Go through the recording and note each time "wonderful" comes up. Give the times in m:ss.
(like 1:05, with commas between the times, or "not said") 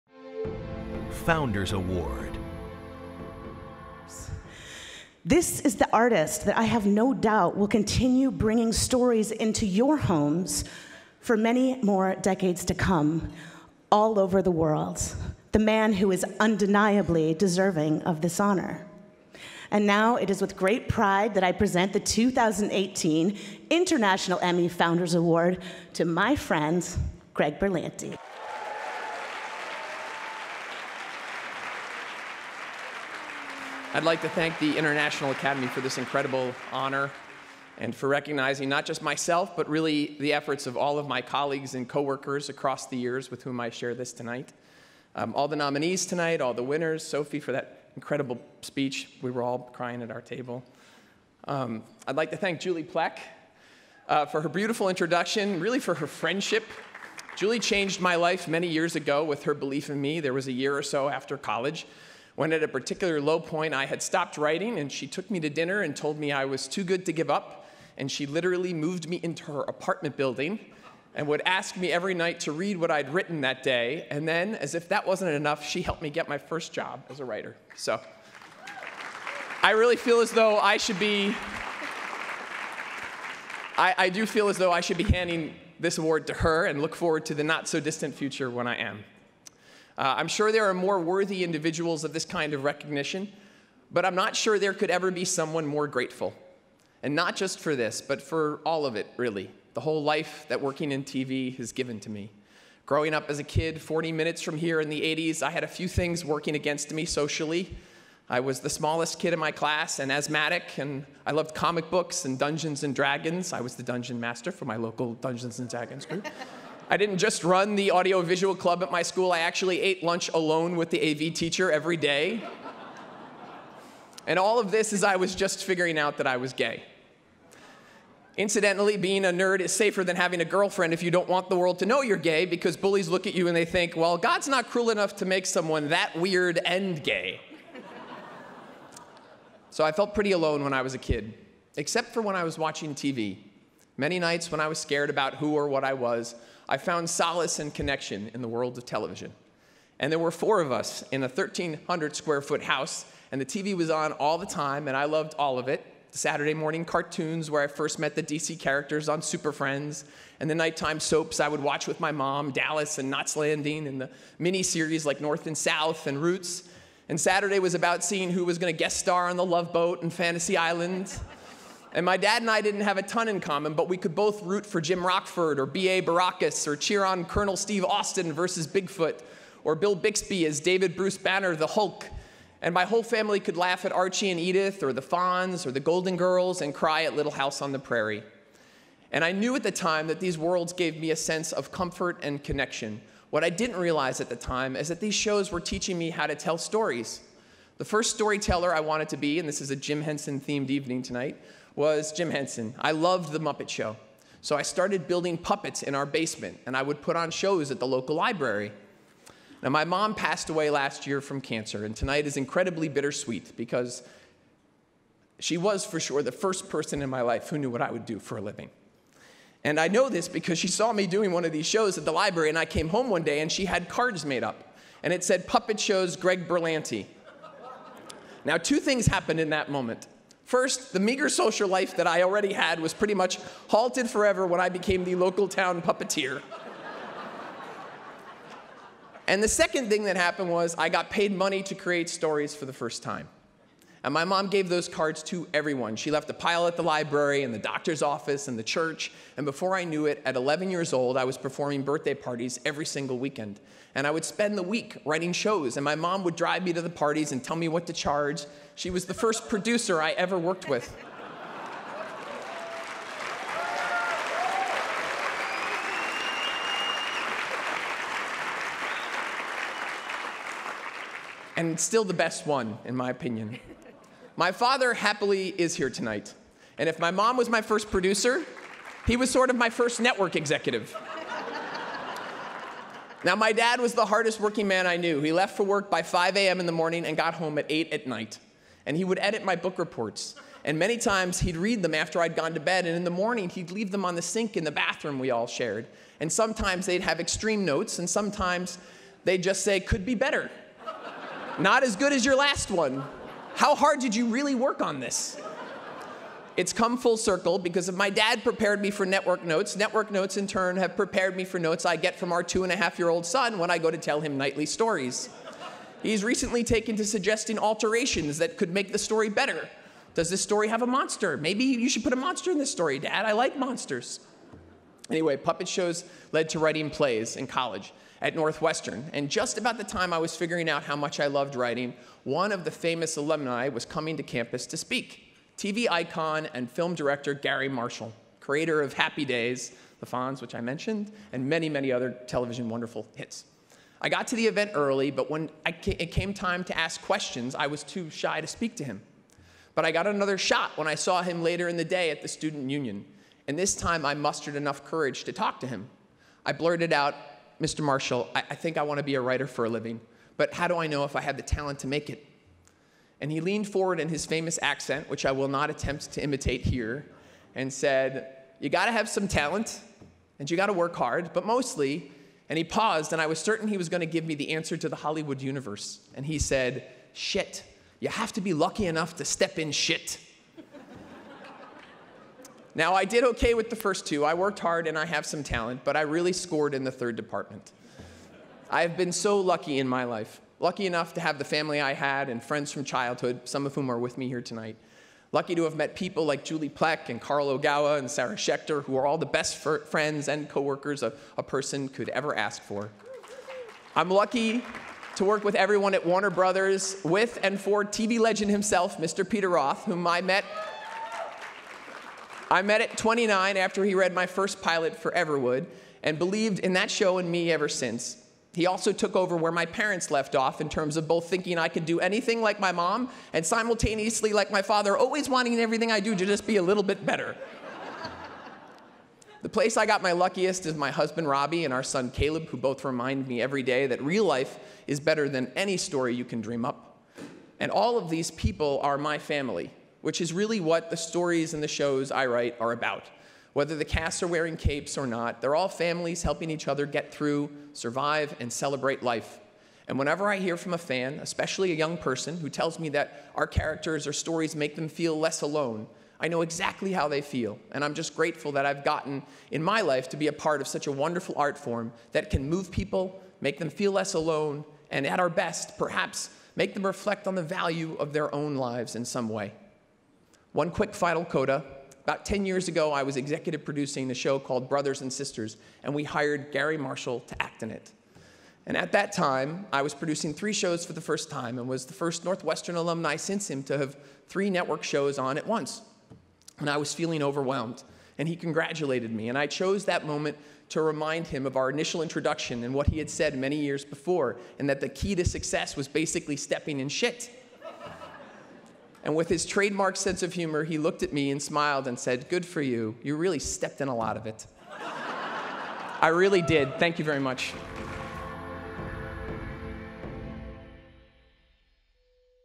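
5:42, 7:40.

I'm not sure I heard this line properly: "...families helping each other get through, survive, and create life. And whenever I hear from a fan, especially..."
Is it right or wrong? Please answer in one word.
wrong.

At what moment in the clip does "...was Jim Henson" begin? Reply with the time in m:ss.
3:21.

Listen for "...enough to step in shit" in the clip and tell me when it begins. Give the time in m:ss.
6:18.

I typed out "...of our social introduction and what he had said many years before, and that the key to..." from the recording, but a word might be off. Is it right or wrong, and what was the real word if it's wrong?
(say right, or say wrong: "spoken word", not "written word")
wrong: "initial", not "social".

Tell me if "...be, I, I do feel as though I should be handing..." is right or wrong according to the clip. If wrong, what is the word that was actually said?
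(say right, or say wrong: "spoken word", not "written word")
right.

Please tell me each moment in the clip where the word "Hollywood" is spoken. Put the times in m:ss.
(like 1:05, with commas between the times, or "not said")
6:14.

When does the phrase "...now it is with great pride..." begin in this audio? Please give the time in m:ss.
0:19.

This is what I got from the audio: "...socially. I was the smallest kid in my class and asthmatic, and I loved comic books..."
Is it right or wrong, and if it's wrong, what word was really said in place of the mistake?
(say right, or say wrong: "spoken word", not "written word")
right.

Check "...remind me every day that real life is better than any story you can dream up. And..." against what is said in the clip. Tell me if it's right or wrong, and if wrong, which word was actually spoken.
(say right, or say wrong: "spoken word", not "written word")
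right.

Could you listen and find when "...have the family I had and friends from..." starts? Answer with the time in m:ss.
6:31.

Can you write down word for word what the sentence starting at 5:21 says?
Maybe you should put a monster in this story, Dad.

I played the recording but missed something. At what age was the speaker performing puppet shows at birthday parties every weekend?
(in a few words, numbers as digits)
11.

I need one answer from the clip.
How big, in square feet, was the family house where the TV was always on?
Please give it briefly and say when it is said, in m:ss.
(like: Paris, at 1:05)
1,300, at 2:31.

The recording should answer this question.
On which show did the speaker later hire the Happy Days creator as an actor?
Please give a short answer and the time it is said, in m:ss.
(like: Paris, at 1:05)
Brothers and Sisters, at 7:54.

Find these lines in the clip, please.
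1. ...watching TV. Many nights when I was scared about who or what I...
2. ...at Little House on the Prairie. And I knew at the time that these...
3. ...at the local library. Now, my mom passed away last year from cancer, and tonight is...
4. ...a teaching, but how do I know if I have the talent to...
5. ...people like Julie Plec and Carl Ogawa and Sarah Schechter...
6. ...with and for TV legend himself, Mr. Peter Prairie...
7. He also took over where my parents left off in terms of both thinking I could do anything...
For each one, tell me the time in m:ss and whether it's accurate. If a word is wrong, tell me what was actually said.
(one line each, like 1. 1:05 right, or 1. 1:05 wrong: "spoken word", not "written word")
1. 2:22 right
2. 3:07 right
3. 3:27 right
4. 5:59 wrong: "living", not "teaching"
5. 6:35 right
6. 6:47 wrong: "Roth", not "Prairie"
7. 6:58 right.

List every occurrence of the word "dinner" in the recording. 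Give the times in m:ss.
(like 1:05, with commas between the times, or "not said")
1:05.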